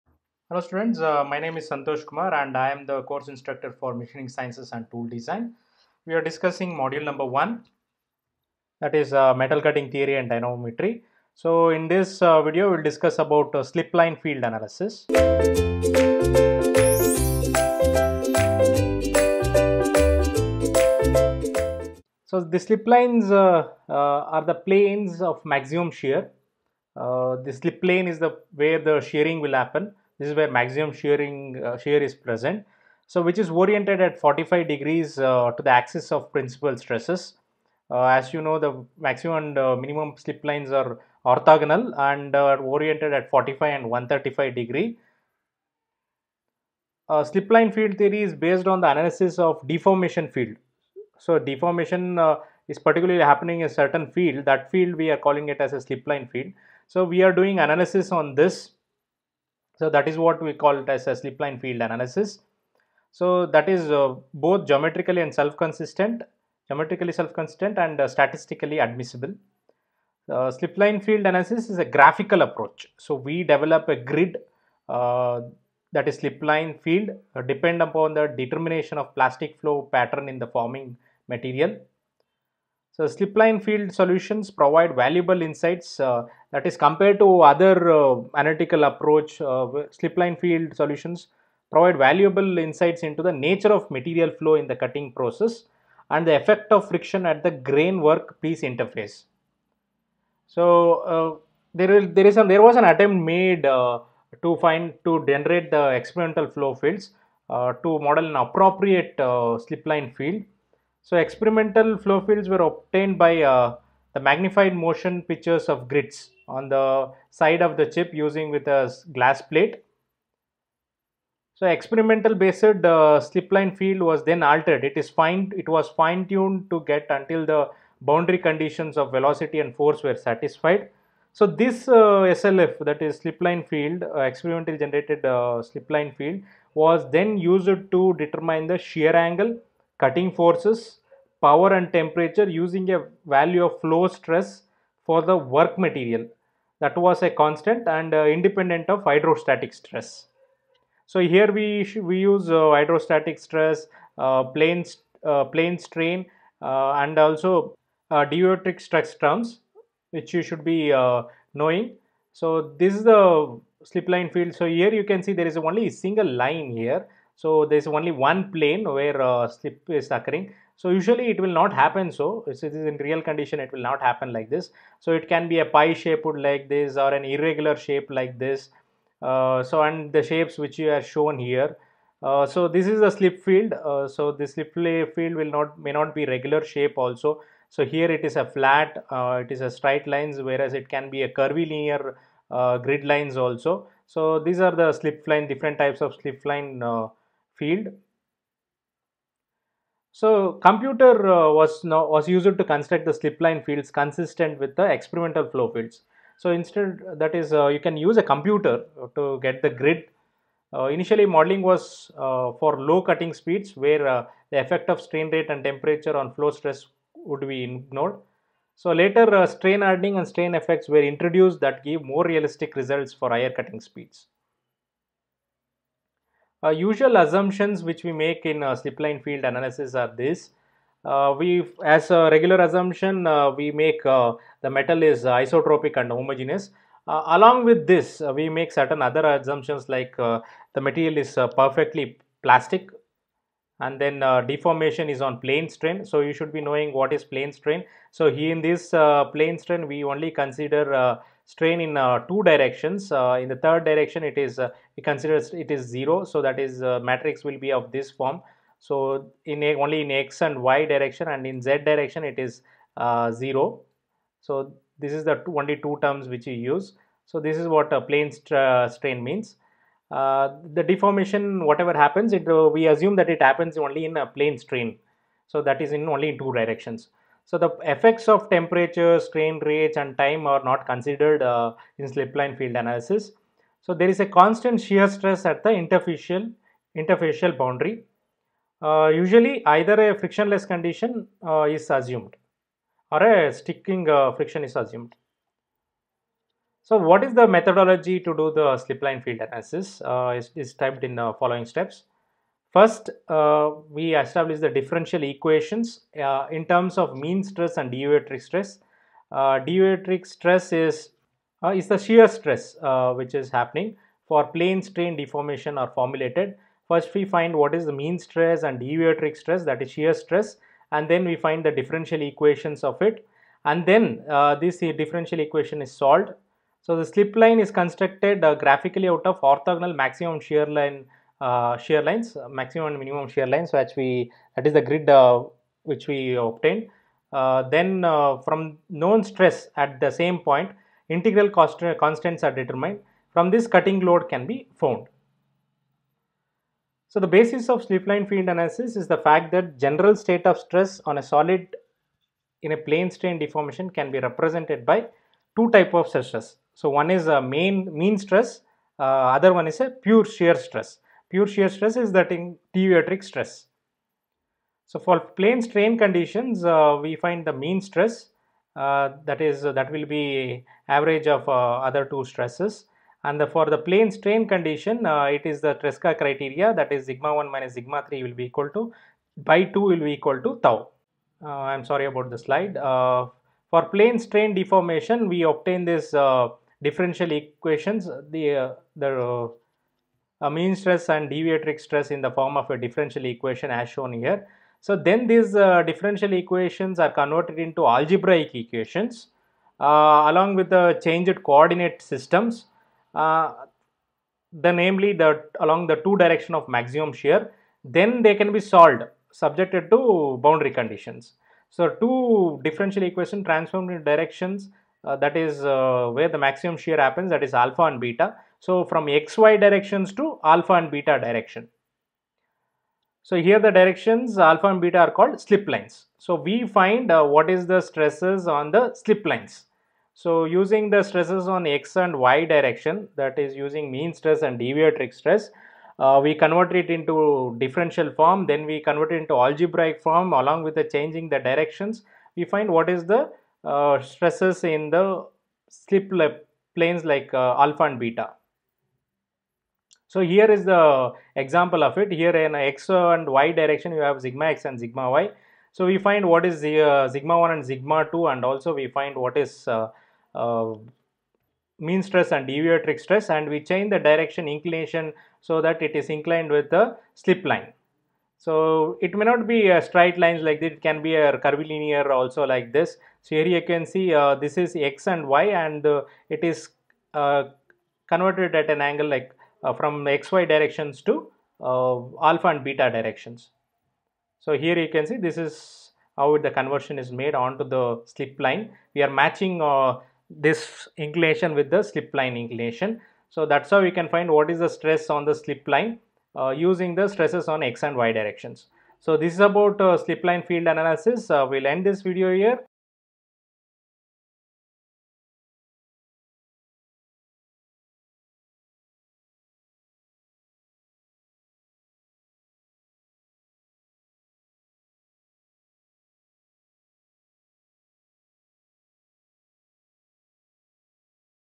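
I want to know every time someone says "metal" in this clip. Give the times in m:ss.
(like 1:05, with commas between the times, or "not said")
0:09, 3:54.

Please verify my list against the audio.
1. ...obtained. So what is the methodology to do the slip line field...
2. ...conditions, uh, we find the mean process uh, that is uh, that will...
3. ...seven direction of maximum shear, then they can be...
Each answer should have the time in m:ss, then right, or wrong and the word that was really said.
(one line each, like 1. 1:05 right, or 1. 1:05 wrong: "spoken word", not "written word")
1. 4:54 wrong: "assumed", not "obtained"
2. 6:05 wrong: "stress", not "process"
3. 6:45 wrong: "two", not "seven".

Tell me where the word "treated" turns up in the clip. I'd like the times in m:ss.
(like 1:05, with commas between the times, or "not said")
not said.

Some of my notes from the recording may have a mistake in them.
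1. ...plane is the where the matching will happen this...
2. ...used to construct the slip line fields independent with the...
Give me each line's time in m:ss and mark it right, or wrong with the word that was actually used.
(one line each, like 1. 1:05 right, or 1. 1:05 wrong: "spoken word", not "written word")
1. 0:27 wrong: "shearing", not "matching"
2. 3:22 wrong: "consistent", not "independent".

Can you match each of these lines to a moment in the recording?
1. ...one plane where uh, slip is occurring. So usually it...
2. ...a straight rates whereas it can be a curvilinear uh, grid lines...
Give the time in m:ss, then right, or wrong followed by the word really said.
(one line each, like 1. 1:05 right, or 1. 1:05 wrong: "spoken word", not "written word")
1. 2:48 right
2. 3:09 wrong: "lines", not "rates".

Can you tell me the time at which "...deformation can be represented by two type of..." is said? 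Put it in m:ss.
5:53.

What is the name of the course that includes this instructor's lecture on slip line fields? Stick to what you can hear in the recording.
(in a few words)
Machining Sciences and Tool Design.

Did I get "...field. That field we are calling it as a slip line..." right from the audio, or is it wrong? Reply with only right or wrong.
right.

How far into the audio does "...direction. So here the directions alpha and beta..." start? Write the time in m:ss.
7:01.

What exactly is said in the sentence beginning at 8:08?
We are matching uh, this inclination with the slip line inclination.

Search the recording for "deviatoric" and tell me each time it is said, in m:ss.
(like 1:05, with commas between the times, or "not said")
5:07, 5:18, 6:02, 6:31, 7:14, 7:42.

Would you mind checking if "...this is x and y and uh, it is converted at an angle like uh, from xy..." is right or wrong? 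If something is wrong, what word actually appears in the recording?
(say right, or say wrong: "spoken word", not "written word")
right.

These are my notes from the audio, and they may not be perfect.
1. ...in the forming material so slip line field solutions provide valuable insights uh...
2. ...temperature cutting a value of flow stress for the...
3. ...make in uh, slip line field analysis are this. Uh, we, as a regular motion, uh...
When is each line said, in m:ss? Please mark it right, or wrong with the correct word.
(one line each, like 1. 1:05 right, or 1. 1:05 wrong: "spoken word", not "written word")
1. 1:20 right
2. 2:21 wrong: "using", not "cutting"
3. 3:48 wrong: "assumption", not "motion".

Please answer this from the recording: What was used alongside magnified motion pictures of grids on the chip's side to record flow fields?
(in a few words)
a glass plate.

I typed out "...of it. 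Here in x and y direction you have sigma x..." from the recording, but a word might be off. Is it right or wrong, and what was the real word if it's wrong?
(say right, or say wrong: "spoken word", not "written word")
right.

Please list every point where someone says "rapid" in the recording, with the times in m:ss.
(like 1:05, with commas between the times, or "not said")
not said.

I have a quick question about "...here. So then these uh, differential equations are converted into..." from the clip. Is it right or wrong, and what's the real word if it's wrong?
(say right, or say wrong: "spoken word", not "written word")
right.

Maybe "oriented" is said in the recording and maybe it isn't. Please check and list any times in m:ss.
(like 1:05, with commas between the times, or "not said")
0:33, 0:42.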